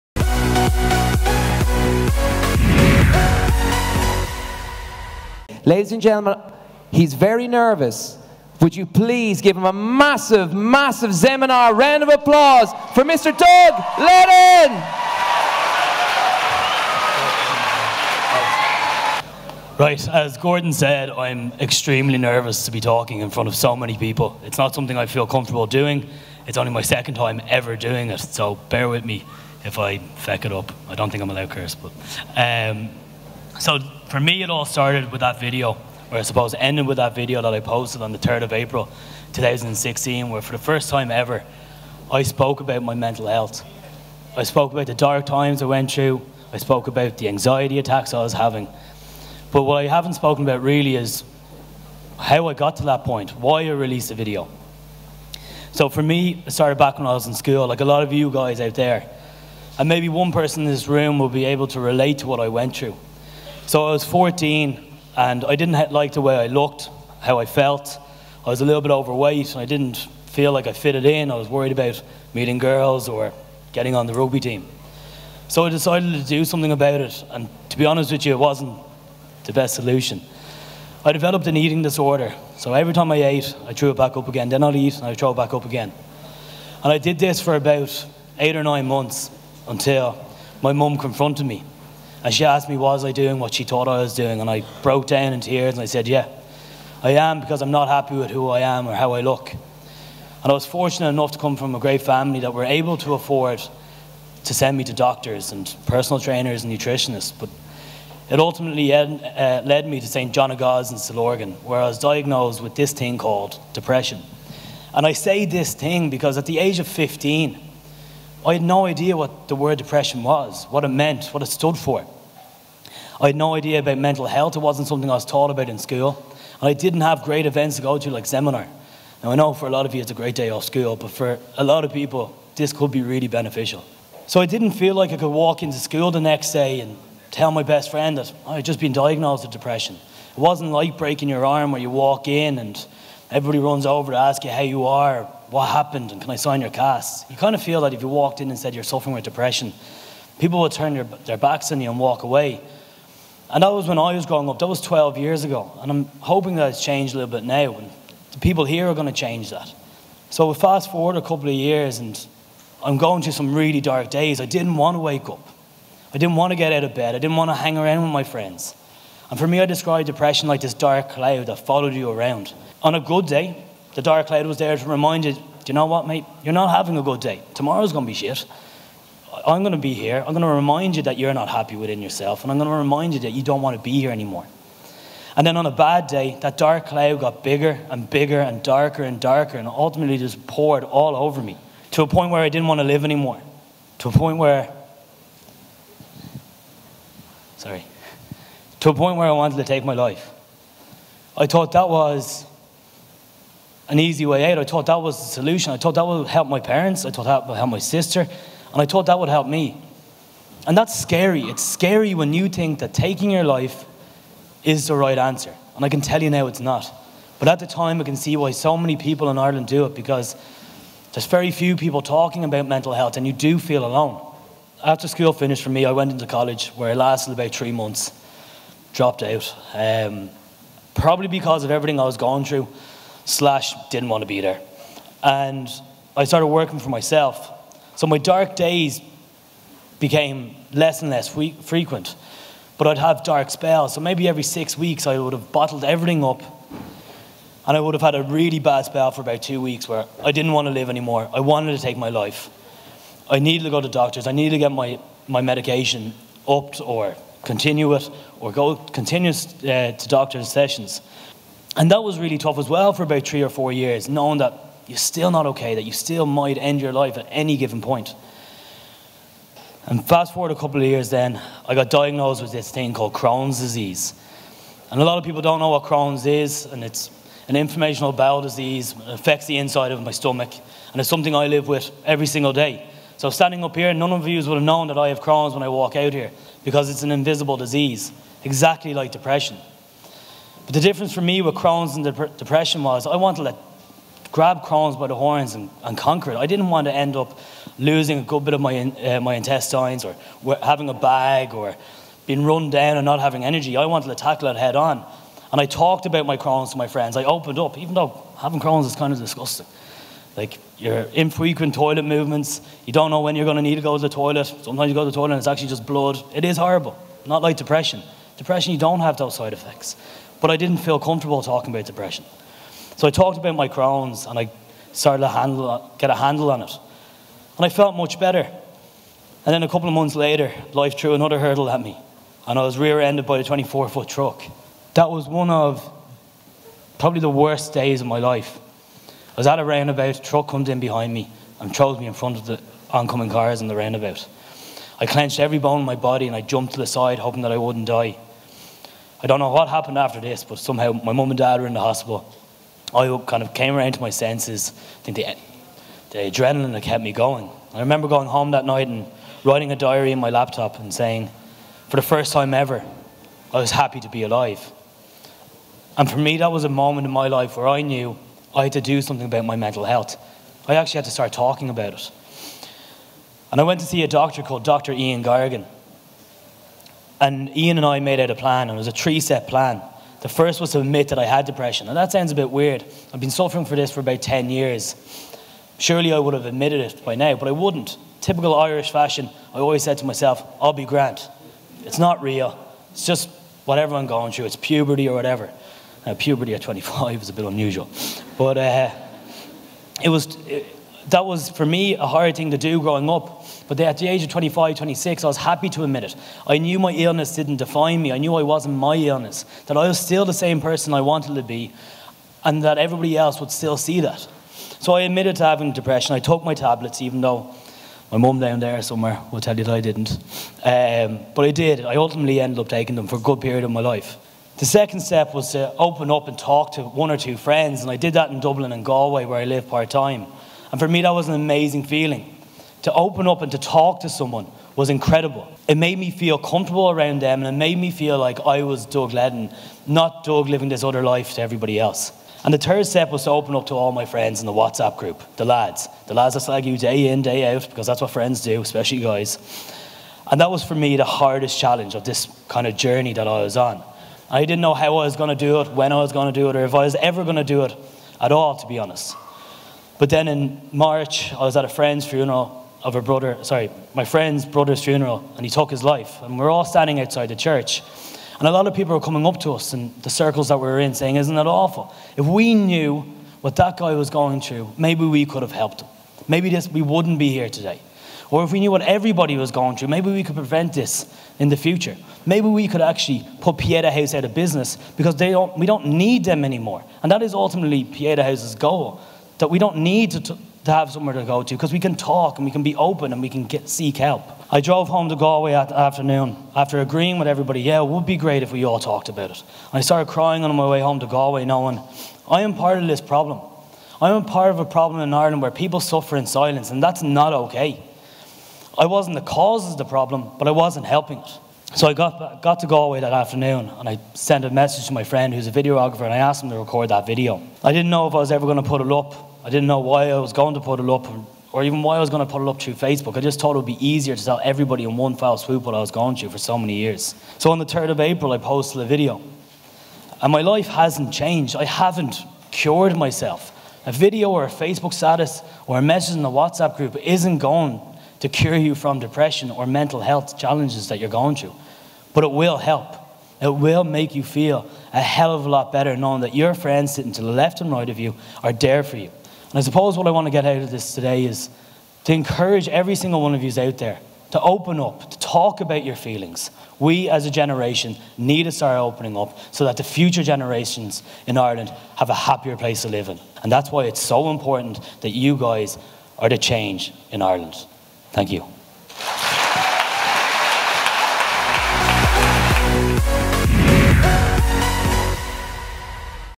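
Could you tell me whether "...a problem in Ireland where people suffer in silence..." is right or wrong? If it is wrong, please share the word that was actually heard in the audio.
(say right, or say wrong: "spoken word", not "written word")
right.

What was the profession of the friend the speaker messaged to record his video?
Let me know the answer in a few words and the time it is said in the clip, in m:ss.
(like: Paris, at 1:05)
Videographer, at 8:35.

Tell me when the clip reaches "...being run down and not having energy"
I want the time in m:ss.
5:02.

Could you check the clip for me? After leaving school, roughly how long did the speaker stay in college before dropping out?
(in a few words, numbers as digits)
About three months.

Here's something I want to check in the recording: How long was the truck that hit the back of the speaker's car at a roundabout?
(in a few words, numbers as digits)
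24 foot.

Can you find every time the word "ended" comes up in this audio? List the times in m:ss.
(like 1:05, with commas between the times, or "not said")
0:36, 5:32, 7:02.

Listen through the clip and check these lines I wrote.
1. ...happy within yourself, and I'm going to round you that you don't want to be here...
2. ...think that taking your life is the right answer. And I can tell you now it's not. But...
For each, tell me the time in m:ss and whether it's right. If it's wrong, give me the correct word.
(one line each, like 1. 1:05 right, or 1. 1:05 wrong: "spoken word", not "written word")
1. 3:01 wrong: "remind", not "round"
2. 3:32 right.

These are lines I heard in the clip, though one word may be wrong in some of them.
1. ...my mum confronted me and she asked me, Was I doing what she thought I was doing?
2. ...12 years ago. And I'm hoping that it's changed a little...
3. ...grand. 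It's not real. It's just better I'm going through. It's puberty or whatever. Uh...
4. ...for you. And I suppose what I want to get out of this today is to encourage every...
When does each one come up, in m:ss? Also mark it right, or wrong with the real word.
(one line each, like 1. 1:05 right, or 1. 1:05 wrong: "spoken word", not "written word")
1. 1:30 right
2. 2:34 right
3. 6:30 wrong: "whatever", not "better"
4. 9:08 right.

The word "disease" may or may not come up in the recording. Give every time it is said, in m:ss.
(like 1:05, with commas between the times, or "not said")
4:33, 4:38, 4:47.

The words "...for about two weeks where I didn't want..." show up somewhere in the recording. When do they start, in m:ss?
4:09.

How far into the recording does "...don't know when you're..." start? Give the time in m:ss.
5:12.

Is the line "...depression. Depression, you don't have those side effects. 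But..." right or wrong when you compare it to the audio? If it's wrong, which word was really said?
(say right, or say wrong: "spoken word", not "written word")
right.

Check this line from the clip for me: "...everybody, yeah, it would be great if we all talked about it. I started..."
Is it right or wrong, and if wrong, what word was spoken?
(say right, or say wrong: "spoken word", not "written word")
right.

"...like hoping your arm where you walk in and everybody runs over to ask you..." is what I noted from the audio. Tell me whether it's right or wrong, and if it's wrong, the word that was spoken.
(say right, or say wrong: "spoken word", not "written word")
wrong: "breaking", not "hoping".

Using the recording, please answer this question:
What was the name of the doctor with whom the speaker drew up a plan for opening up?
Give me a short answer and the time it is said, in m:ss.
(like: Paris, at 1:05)
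Dr. Ian Gargan, at 6:14.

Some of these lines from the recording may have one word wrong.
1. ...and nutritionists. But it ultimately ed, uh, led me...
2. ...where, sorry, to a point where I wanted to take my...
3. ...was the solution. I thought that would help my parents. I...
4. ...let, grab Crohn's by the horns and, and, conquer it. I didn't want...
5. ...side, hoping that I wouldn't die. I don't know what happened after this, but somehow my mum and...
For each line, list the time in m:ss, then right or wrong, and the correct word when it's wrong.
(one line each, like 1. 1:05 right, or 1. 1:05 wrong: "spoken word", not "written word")
1. 1:46 right
2. 3:14 right
3. 3:25 right
4. 4:53 right
5. 5:46 right.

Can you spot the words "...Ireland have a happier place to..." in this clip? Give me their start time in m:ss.
9:21.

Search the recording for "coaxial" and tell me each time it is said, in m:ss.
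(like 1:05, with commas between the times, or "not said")
not said.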